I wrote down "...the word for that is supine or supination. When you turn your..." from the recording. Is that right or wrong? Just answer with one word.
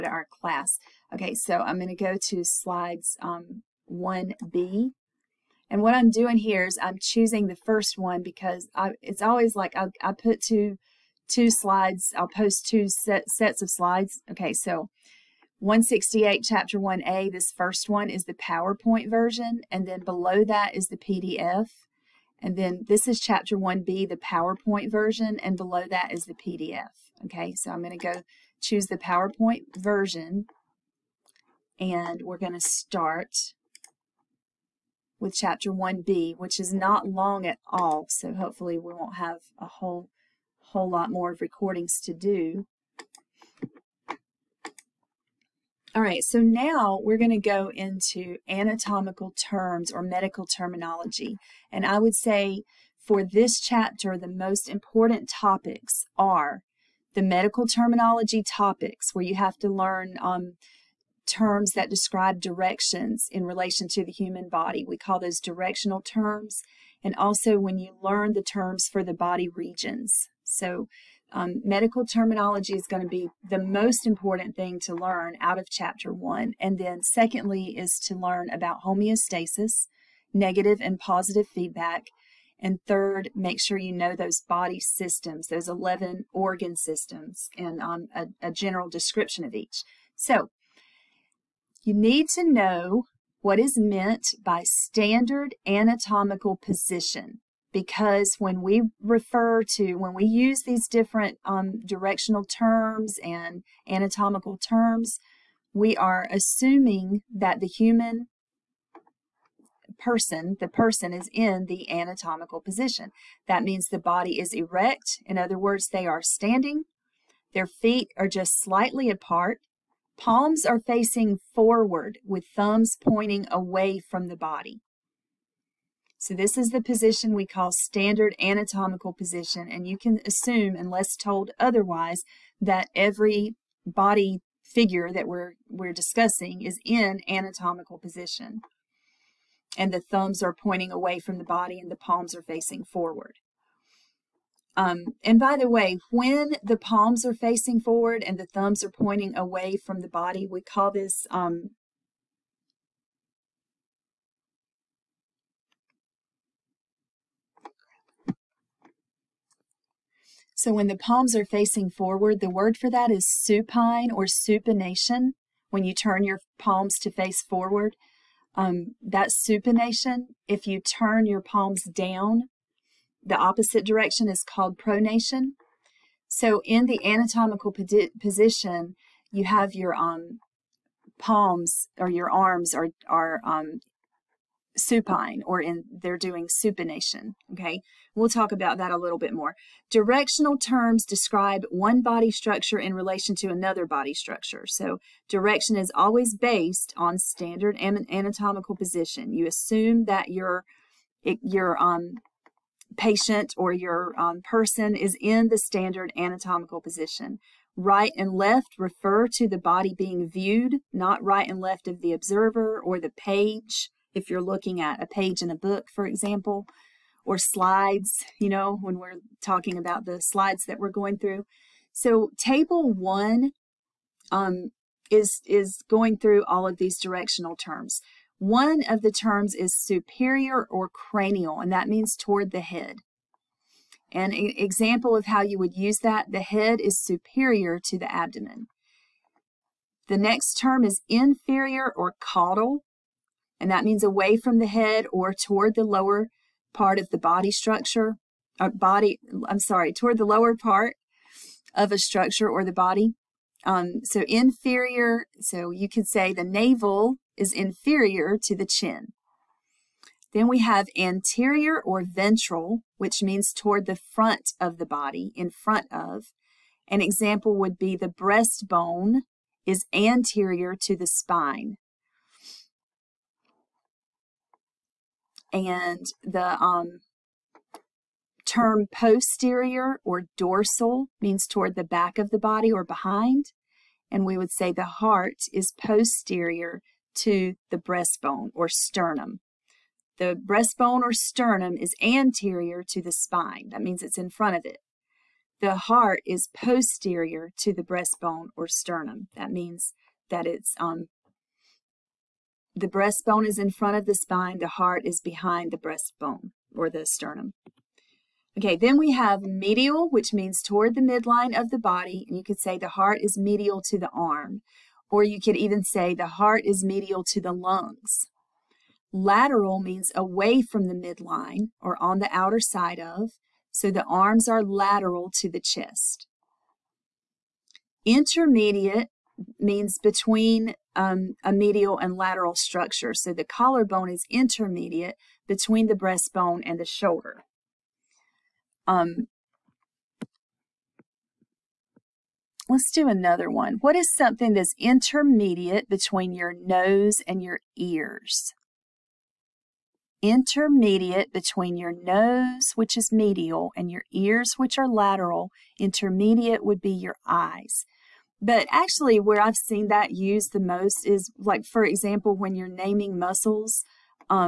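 right.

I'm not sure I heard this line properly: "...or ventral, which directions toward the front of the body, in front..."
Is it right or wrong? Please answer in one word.
wrong.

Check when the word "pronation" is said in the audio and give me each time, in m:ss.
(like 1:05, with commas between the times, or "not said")
2:54.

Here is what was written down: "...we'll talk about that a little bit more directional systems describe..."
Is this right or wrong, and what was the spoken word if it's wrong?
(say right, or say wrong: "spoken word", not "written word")
wrong: "terms", not "systems".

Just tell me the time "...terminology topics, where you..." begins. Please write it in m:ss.
0:57.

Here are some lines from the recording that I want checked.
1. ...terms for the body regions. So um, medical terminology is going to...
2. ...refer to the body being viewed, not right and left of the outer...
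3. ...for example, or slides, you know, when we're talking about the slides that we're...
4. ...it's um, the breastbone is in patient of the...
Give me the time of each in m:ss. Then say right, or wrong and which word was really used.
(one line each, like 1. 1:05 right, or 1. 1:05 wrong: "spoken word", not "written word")
1. 1:08 right
2. 3:28 wrong: "observer", not "outer"
3. 3:35 right
4. 5:00 wrong: "front", not "patient".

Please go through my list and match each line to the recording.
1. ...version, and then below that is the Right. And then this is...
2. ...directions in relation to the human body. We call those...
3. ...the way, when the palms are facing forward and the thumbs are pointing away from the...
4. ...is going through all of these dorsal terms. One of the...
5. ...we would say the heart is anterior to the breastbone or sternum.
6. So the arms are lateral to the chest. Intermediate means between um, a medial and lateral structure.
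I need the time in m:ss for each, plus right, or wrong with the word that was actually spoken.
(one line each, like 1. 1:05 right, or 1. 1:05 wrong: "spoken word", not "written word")
1. 0:19 wrong: "PDF", not "Right"
2. 1:02 right
3. 2:25 right
4. 3:45 wrong: "directional", not "dorsal"
5. 4:44 wrong: "posterior", not "anterior"
6. 5:23 right.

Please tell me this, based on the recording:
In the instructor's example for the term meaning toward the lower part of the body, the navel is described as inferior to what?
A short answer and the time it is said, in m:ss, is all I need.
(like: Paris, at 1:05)
the chin, at 4:18.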